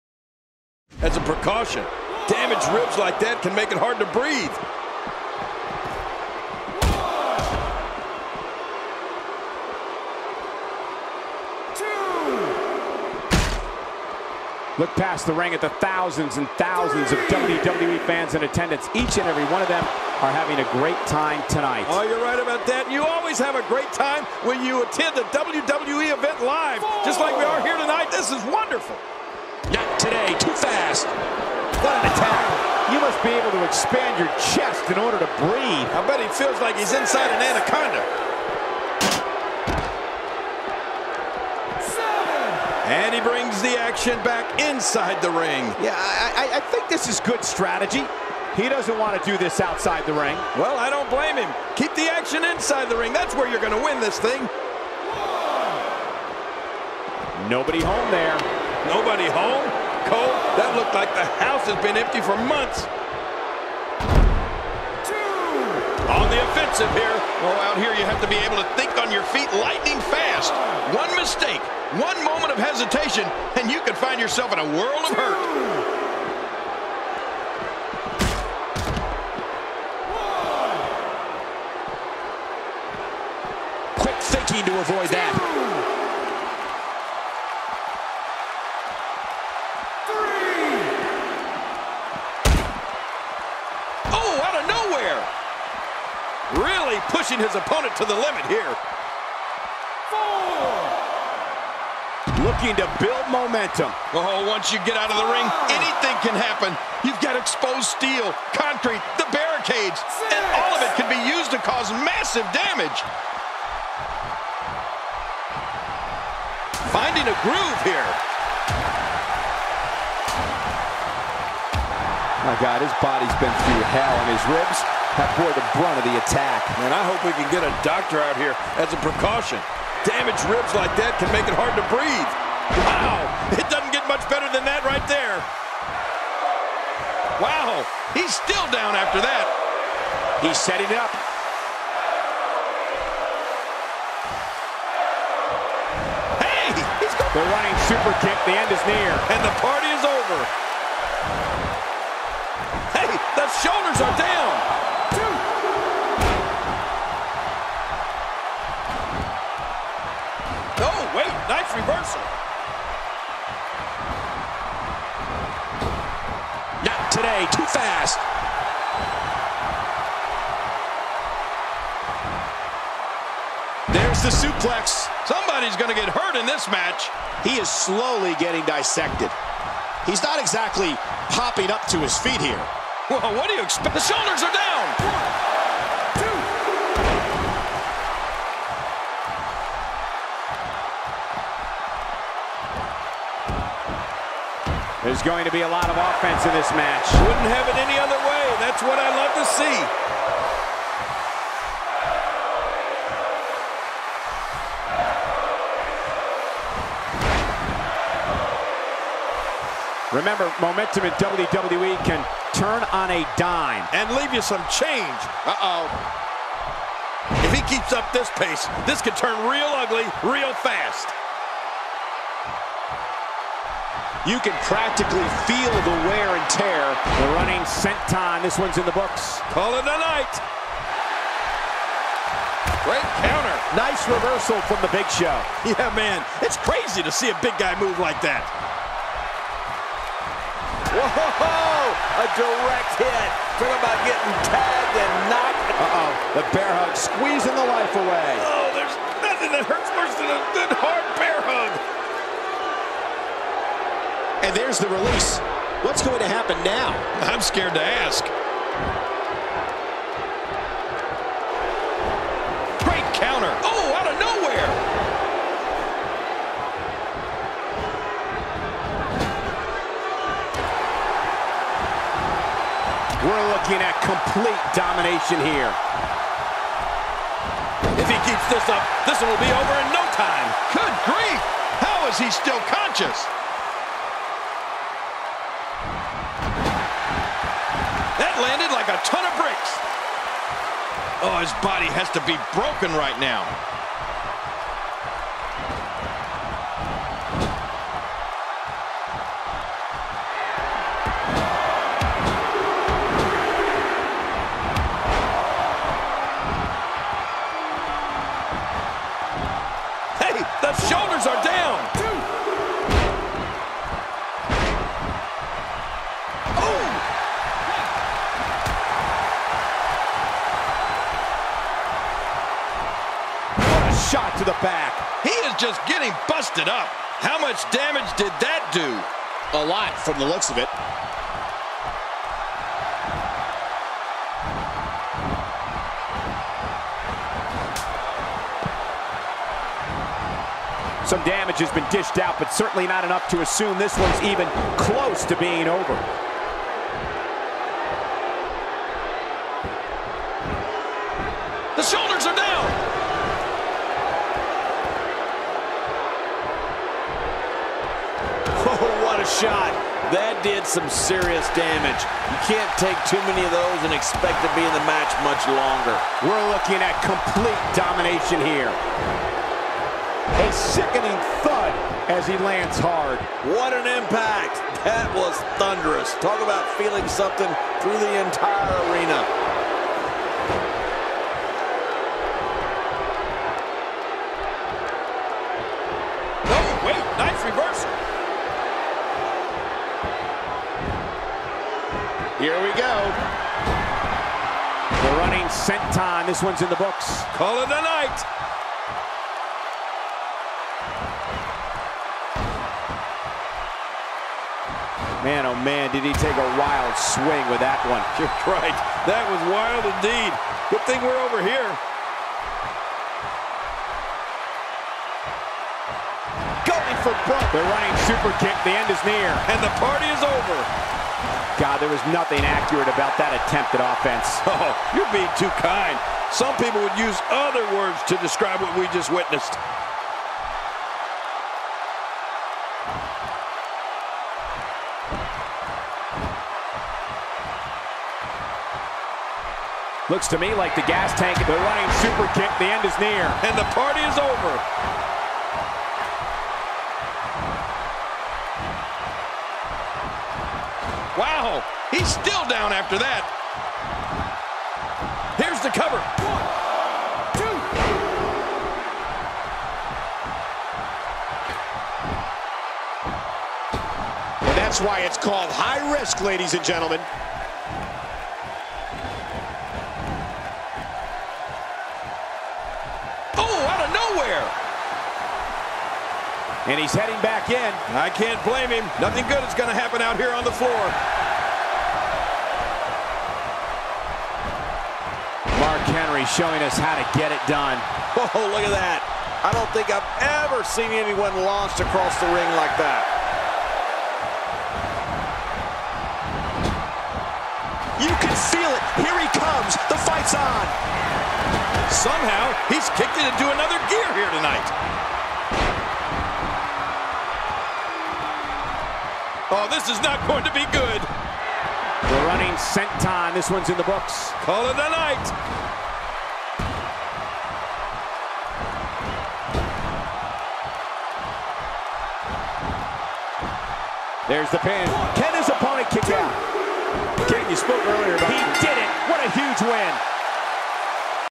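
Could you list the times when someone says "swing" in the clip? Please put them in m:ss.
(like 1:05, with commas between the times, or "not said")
6:46.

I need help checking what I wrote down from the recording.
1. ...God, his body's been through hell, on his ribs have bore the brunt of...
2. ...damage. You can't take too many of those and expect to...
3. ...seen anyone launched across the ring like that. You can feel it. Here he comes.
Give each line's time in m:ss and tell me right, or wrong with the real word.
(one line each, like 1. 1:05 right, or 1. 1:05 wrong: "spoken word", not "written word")
1. 2:02 right
2. 6:01 right
3. 8:10 right.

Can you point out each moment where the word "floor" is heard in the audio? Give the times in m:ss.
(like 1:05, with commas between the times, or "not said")
8:00.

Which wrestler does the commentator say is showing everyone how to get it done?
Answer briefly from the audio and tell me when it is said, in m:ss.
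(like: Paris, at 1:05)
Mark Henry, at 8:05.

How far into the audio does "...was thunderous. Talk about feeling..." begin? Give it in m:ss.
6:15.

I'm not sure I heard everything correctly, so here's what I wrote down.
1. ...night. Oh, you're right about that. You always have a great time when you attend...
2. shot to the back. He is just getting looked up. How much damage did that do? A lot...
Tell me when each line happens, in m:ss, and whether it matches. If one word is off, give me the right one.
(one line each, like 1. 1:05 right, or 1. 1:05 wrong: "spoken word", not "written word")
1. 0:21 wrong: "tonight", not "night"
2. 5:24 wrong: "busted", not "looked".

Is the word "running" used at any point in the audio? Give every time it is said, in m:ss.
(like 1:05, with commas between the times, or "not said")
2:27, 3:47, 6:57, 7:21, 8:32.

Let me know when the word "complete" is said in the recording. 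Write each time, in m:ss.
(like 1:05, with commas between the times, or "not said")
4:34, 6:07.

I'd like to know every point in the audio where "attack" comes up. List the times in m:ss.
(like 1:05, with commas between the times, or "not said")
0:32, 2:06.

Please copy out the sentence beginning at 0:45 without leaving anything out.
Yeah, I, I, I think this is good strategy.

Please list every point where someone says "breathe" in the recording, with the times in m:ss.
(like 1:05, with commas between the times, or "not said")
0:04, 0:35, 2:11.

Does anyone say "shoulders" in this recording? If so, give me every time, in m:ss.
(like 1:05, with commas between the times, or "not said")
2:33, 3:04, 5:51.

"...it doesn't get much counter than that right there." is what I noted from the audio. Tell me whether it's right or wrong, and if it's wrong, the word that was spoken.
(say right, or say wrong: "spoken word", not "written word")
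wrong: "better", not "counter".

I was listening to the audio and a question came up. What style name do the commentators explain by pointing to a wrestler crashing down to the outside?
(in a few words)
High risk.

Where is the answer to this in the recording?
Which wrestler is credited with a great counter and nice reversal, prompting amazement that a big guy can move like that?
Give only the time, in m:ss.
3:54.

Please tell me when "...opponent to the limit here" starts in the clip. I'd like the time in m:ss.
1:37.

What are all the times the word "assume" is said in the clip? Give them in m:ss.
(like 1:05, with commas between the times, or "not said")
5:43.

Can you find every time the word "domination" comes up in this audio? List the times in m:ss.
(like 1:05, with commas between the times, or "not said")
4:34, 6:07.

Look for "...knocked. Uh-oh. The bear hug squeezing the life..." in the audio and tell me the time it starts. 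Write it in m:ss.
4:05.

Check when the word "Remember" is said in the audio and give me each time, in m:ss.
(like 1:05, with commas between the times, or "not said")
3:30.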